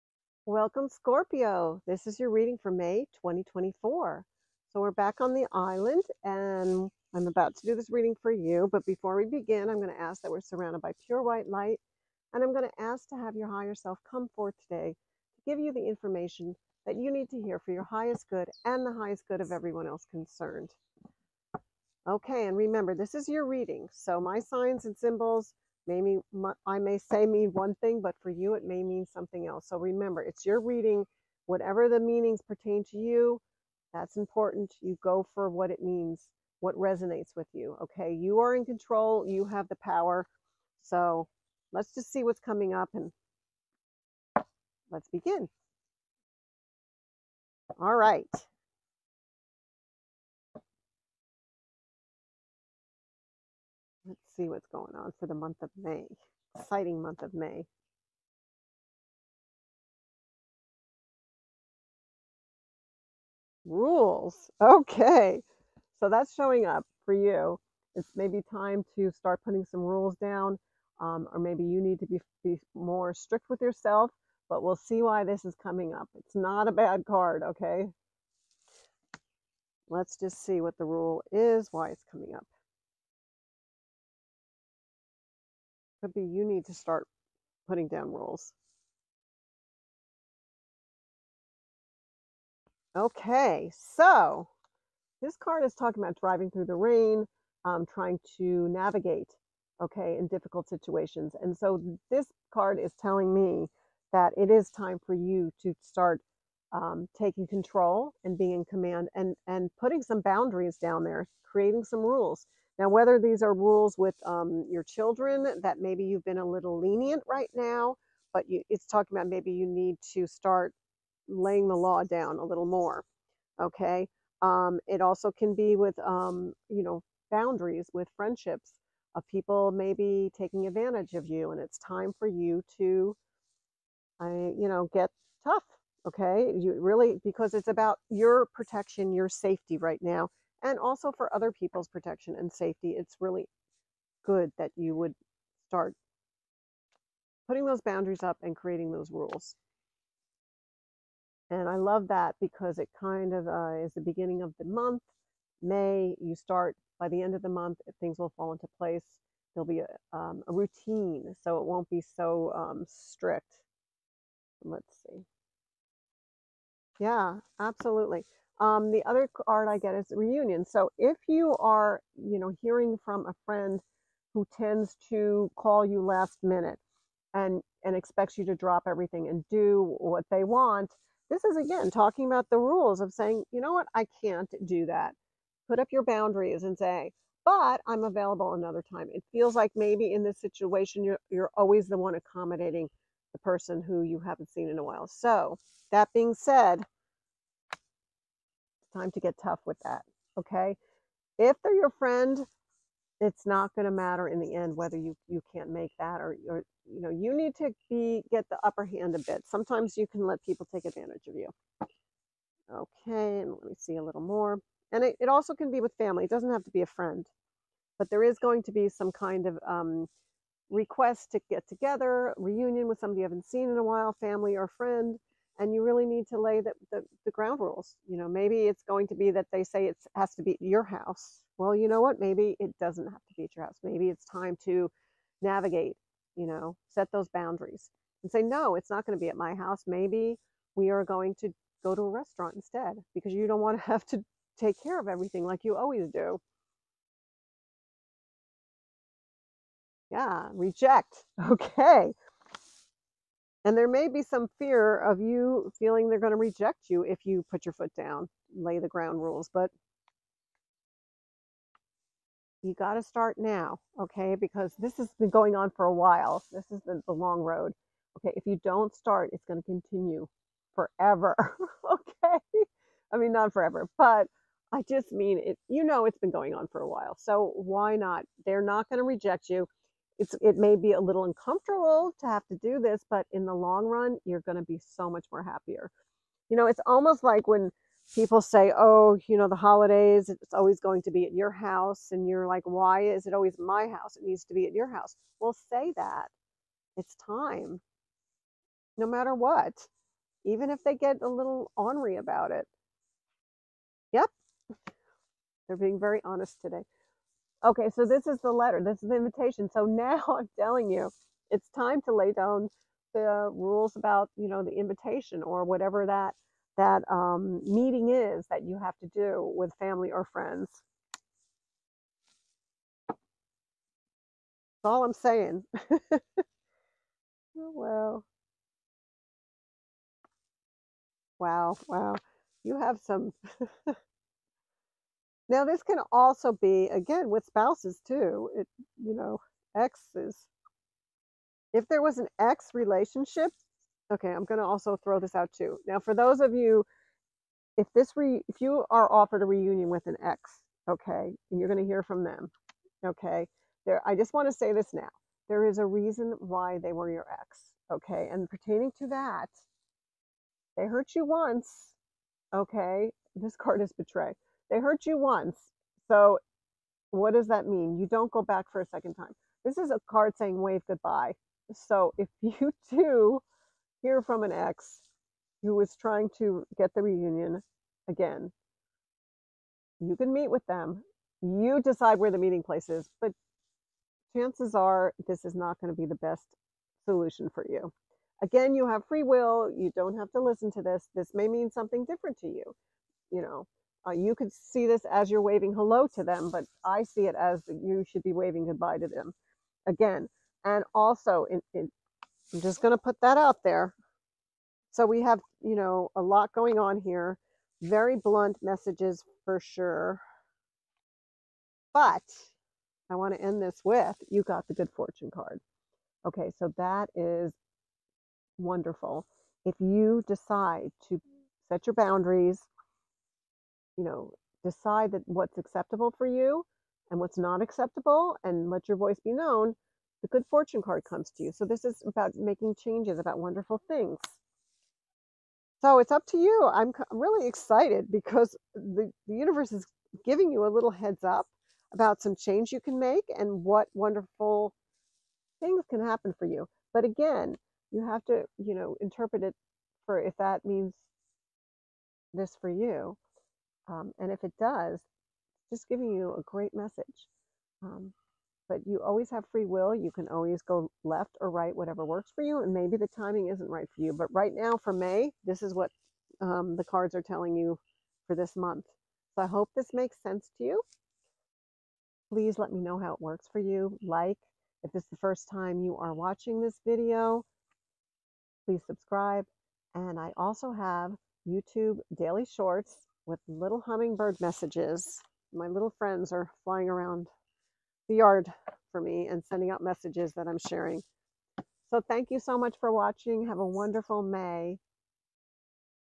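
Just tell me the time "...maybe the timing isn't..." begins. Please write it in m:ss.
7:42.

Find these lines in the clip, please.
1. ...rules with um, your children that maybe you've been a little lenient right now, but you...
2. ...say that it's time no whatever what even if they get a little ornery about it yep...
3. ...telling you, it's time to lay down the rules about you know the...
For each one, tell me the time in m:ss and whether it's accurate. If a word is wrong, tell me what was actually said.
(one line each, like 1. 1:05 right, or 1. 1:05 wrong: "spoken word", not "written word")
1. 1:53 right
2. 4:55 wrong: "matter", not "whatever"
3. 5:10 right.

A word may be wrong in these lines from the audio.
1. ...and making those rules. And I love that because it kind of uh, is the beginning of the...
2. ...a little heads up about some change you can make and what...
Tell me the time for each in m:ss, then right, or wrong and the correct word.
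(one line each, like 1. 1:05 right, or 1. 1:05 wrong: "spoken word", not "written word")
1. 2:28 wrong: "creating", not "making"
2. 7:20 right.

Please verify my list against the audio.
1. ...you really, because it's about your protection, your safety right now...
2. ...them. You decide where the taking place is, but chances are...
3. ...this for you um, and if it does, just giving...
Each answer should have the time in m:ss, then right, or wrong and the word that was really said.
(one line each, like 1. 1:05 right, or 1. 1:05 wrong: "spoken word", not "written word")
1. 2:16 right
2. 6:20 wrong: "meeting", not "taking"
3. 7:32 right.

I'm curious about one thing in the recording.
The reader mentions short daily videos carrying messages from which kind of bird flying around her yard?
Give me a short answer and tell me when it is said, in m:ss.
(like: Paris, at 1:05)
Hummingbird, at 8:03.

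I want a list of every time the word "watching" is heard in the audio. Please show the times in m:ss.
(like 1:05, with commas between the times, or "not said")
7:56, 8:12.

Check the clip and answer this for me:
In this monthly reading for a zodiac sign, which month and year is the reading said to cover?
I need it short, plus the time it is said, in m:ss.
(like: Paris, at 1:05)
May 2024, at 0:02.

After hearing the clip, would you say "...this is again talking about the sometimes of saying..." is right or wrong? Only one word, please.
wrong.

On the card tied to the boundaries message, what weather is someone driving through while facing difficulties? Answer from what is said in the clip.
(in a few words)
Rain.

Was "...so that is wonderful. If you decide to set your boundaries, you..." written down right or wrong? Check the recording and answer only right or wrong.
right.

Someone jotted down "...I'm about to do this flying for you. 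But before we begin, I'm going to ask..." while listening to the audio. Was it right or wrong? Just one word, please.
wrong.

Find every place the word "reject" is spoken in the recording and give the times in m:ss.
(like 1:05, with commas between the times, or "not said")
4:10, 4:16, 4:39.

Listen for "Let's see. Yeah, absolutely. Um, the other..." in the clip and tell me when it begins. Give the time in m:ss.
2:44.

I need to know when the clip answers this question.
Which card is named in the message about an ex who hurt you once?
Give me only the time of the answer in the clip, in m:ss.
6:03.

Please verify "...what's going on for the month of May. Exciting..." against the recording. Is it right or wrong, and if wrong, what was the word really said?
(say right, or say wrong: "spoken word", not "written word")
right.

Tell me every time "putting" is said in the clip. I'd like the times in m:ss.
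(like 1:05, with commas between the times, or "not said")
1:09, 1:27, 1:49, 2:27.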